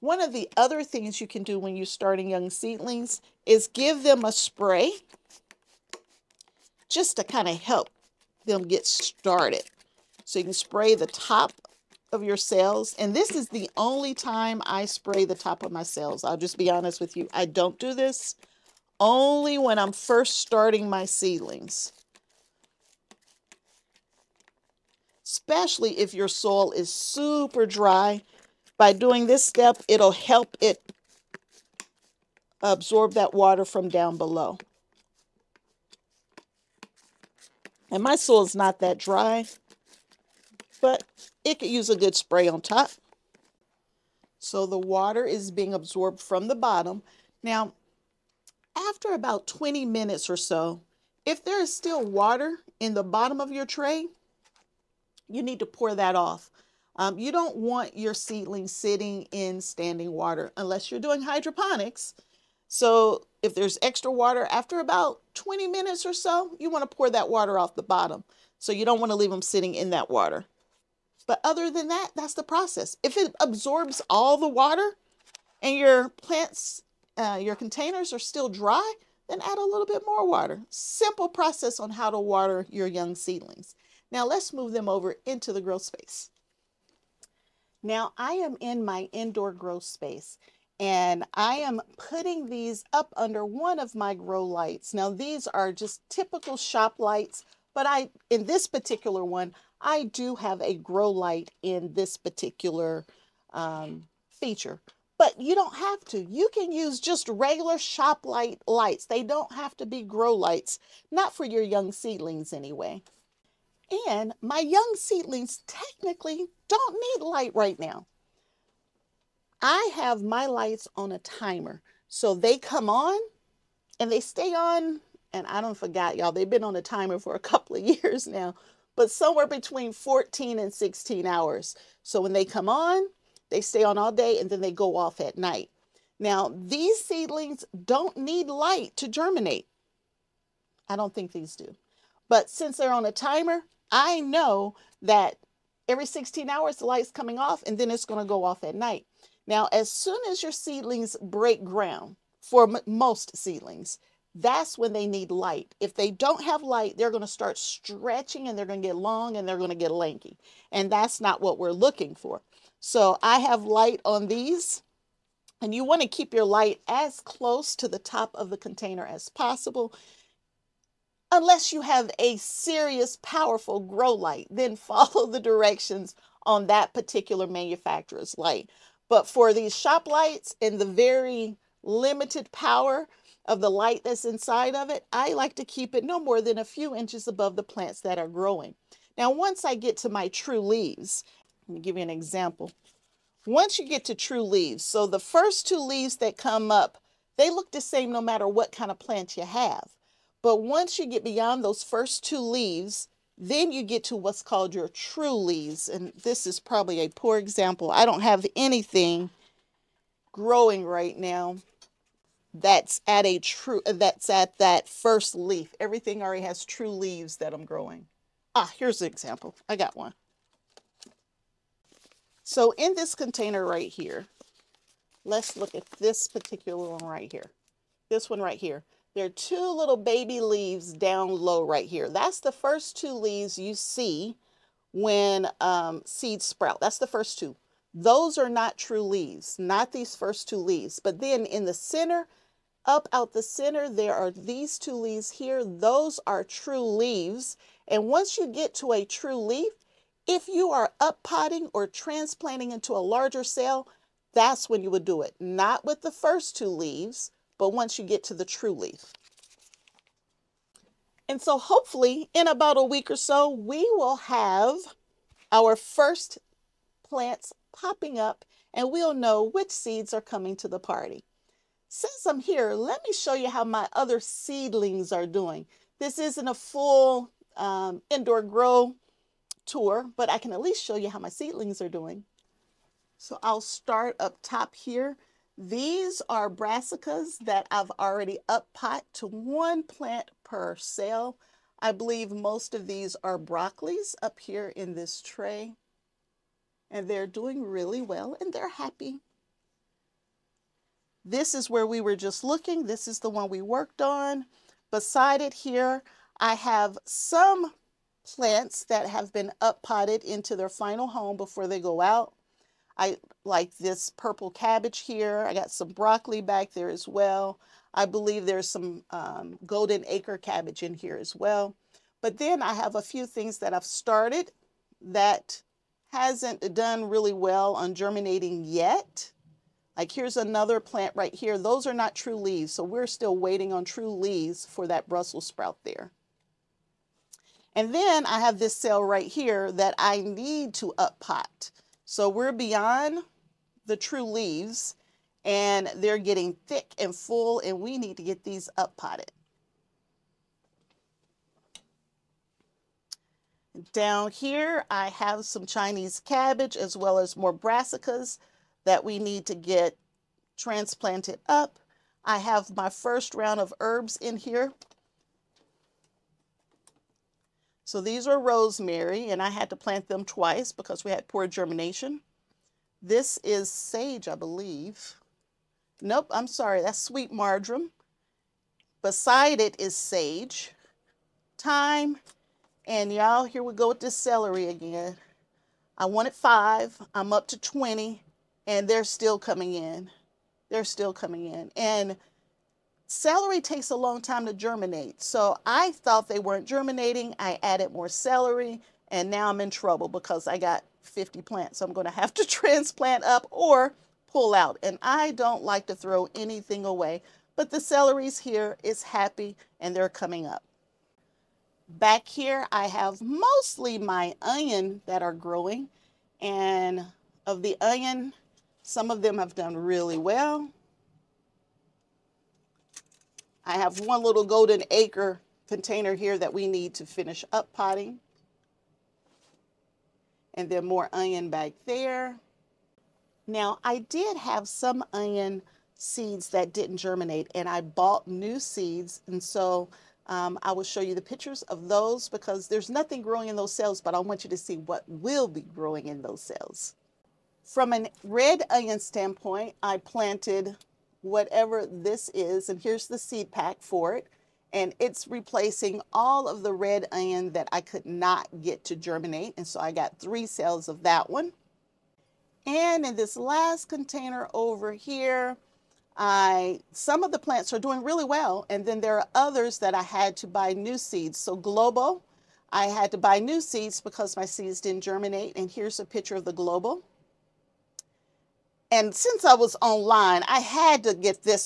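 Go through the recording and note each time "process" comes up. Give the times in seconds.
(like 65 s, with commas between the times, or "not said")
72 s, 81 s.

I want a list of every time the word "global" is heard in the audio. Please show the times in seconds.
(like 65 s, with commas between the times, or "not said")
471 s, 476 s.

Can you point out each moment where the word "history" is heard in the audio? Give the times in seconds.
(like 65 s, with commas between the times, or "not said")
not said.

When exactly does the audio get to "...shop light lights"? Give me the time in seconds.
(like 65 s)
107 s.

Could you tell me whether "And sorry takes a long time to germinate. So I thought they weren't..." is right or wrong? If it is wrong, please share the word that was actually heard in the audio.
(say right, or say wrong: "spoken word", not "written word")
wrong: "celery", not "sorry".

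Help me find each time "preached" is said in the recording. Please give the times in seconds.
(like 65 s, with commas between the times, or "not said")
not said.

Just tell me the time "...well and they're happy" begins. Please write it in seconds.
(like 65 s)
298 s.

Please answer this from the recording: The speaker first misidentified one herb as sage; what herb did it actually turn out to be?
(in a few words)
sweet marjoram.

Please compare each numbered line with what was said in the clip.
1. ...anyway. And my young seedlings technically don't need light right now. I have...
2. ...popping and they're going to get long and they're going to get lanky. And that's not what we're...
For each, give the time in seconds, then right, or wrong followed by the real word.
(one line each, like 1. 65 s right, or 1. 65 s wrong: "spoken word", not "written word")
1. 112 s right
2. 157 s wrong: "stretching", not "popping".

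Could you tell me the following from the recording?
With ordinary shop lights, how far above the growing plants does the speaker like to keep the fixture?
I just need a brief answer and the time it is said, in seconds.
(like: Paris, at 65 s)
a few inches, at 186 s.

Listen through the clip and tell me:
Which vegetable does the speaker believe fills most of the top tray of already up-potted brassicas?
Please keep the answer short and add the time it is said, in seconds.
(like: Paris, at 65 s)
broccoli, at 293 s.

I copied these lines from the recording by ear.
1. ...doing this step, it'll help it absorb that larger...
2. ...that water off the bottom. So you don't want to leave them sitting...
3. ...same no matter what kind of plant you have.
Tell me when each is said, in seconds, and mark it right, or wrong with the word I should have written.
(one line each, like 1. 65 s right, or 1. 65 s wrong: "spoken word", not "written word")
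1. 28 s wrong: "water", not "larger"
2. 67 s right
3. 197 s right.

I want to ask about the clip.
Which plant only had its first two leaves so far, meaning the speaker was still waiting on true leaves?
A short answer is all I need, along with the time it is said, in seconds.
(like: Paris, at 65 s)
Brussels sprout, at 335 s.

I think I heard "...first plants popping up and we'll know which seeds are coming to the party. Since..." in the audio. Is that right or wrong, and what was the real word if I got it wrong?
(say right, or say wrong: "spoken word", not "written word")
right.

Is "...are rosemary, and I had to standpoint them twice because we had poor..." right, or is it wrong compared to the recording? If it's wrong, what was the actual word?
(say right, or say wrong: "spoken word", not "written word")
wrong: "plant", not "standpoint".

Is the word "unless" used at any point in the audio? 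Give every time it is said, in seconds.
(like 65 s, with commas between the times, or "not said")
60 s, 171 s.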